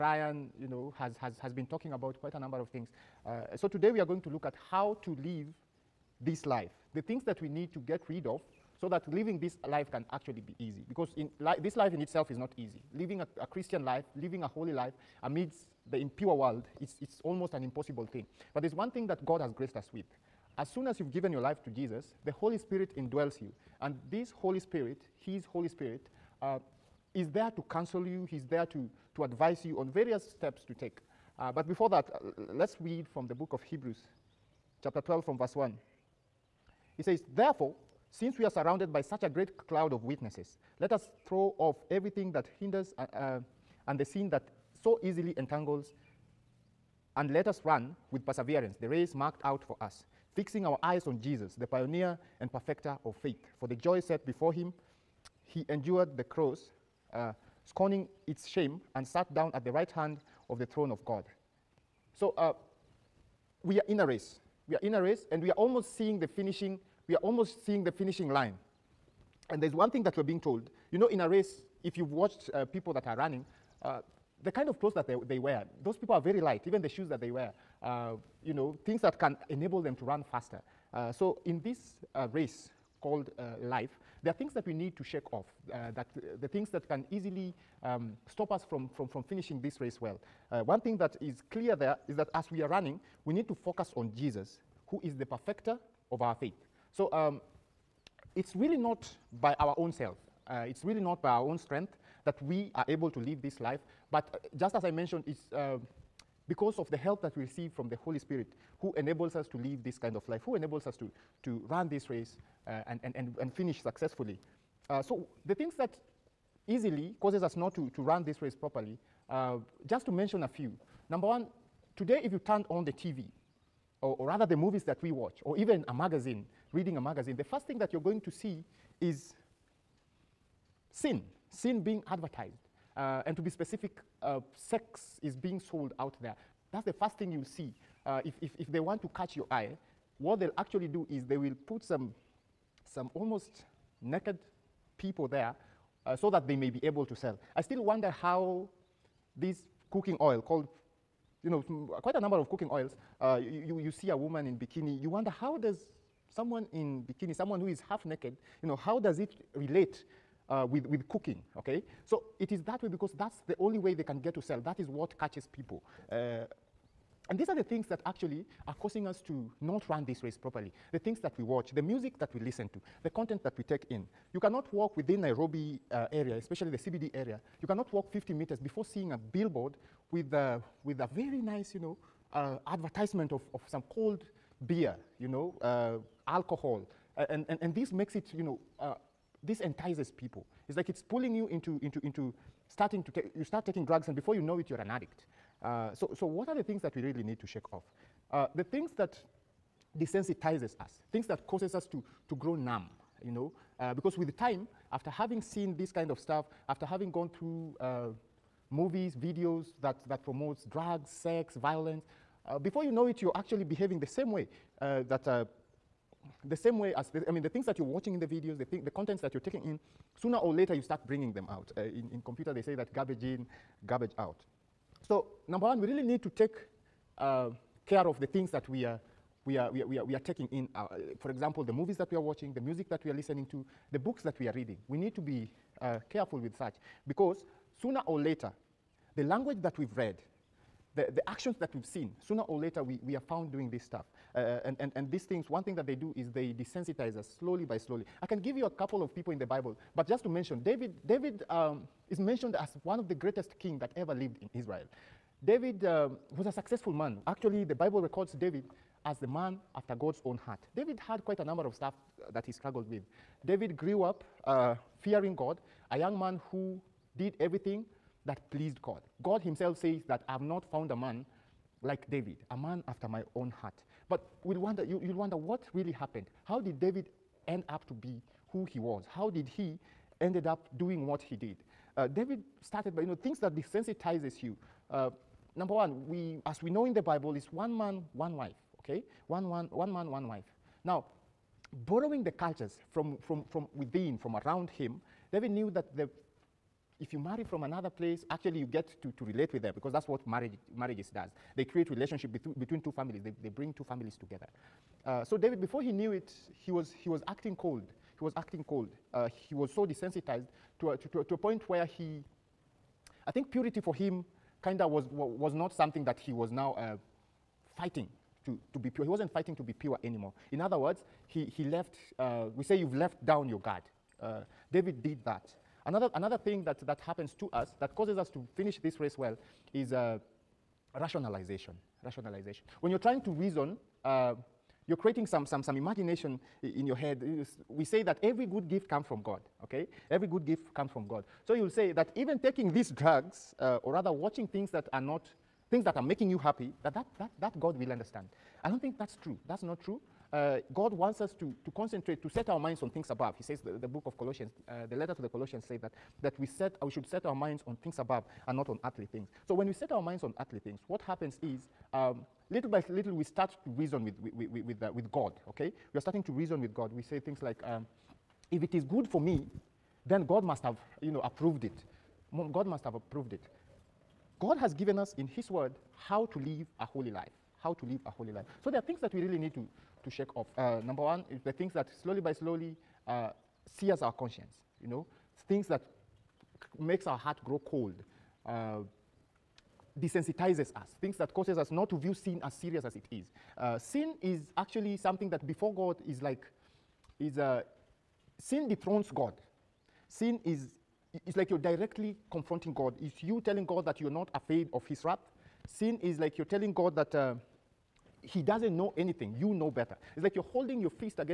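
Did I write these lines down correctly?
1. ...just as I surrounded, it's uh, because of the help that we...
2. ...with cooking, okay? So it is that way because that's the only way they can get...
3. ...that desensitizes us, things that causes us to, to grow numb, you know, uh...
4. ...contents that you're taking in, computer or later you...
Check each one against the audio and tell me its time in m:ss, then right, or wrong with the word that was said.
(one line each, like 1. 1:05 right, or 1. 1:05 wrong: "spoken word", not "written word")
1. 1:44 wrong: "mentioned", not "surrounded"
2. 2:40 right
3. 3:18 right
4. 3:38 wrong: "sooner", not "computer".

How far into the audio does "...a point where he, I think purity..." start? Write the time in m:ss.
5:11.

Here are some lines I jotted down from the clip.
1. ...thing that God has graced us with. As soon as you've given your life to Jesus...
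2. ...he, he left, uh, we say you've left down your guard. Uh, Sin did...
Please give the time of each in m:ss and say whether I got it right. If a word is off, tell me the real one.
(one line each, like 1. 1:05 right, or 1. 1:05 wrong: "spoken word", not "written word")
1. 0:18 right
2. 5:21 wrong: "David", not "Sin".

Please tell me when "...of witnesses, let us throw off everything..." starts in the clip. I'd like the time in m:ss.
0:39.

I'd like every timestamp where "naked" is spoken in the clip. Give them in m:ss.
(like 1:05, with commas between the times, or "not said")
2:24, 2:38.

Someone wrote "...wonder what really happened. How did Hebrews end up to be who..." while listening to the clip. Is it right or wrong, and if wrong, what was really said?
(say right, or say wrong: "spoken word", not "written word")
wrong: "David", not "Hebrews".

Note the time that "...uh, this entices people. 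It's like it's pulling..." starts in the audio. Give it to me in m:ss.
3:08.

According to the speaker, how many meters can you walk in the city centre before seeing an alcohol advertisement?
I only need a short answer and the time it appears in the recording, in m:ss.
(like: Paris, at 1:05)
50, at 2:58.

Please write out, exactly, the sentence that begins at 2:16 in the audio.
That's the first thing you'll see.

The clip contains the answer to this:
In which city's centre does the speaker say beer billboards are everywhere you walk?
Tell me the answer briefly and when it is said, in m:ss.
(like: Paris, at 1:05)
Nairobi, at 2:55.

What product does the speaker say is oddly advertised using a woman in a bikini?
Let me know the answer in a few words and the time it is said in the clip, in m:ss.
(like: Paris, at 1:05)
Cooking oil, at 2:29.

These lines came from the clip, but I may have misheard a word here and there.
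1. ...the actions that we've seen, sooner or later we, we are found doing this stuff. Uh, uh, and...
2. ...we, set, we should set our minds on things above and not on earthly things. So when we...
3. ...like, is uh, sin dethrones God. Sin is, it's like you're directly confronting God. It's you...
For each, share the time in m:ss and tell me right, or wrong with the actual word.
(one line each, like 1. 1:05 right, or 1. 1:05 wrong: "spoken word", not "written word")
1. 4:01 right
2. 5:56 right
3. 6:36 right.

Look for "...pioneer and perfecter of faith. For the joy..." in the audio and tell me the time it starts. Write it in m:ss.
0:51.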